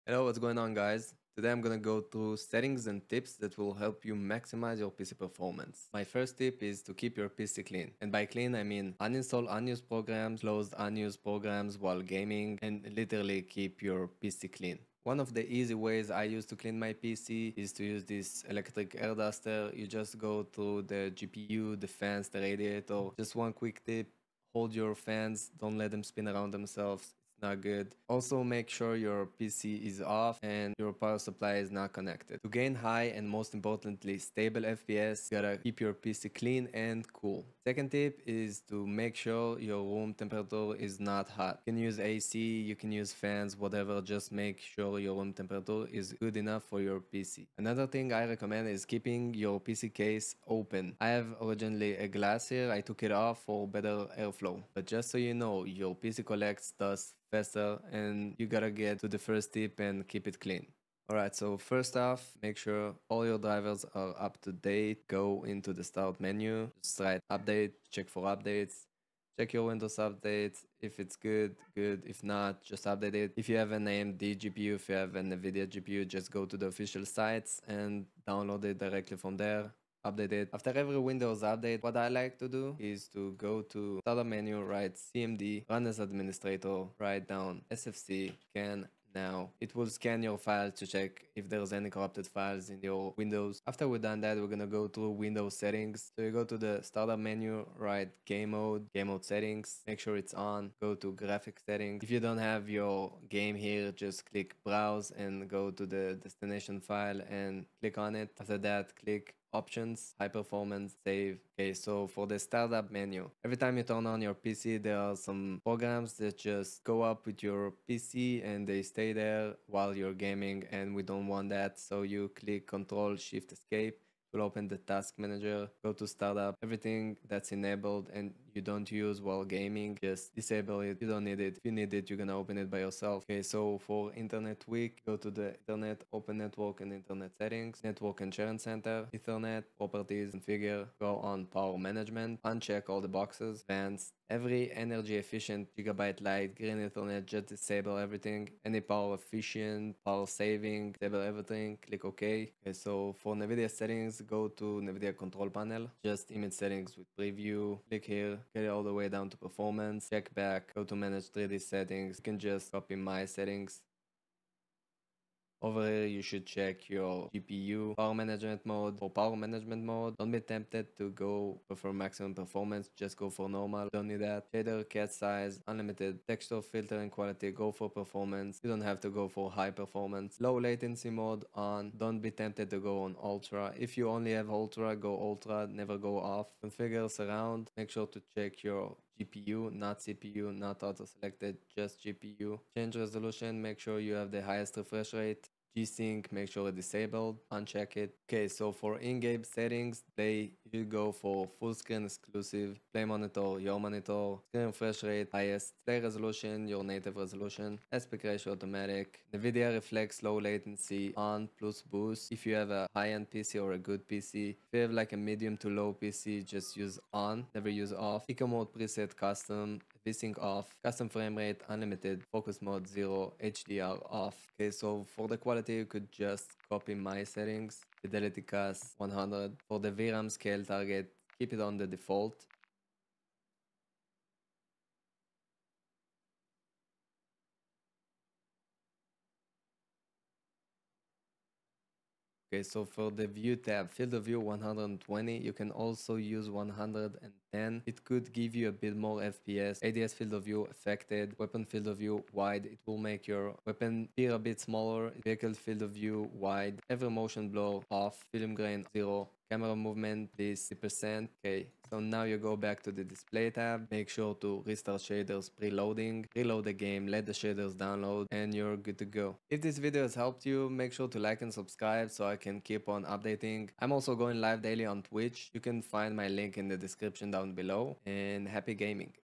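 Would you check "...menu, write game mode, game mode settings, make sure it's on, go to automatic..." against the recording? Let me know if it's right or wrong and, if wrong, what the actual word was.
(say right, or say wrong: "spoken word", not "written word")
wrong: "graphic", not "automatic".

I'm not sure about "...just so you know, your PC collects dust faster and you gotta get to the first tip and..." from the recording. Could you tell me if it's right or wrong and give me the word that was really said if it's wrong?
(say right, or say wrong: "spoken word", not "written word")
right.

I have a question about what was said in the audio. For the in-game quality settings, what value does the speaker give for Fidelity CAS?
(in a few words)
100.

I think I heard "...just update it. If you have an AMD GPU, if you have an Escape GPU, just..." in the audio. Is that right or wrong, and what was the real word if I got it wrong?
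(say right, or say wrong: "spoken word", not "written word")
wrong: "NVIDIA", not "Escape".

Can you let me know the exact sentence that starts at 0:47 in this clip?
Another thing I recommend is keeping your PC case open.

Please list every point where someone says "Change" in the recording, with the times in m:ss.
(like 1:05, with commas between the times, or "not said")
3:12.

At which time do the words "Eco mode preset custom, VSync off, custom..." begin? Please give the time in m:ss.
3:38.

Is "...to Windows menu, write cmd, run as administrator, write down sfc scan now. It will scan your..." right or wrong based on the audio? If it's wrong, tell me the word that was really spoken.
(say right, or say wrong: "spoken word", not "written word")
wrong: "Start", not "Windows".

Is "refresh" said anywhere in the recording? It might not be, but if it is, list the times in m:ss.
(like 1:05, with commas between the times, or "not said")
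3:14, 3:24.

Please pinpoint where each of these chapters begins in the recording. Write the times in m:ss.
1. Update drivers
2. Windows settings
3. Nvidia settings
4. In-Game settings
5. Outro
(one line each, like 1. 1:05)
1. 1:01
2. 1:33
3. 2:33
4. 3:19
5. 4:29.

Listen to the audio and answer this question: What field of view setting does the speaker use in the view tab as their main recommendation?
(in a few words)
120.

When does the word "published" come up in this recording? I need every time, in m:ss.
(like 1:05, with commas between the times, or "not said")
not said.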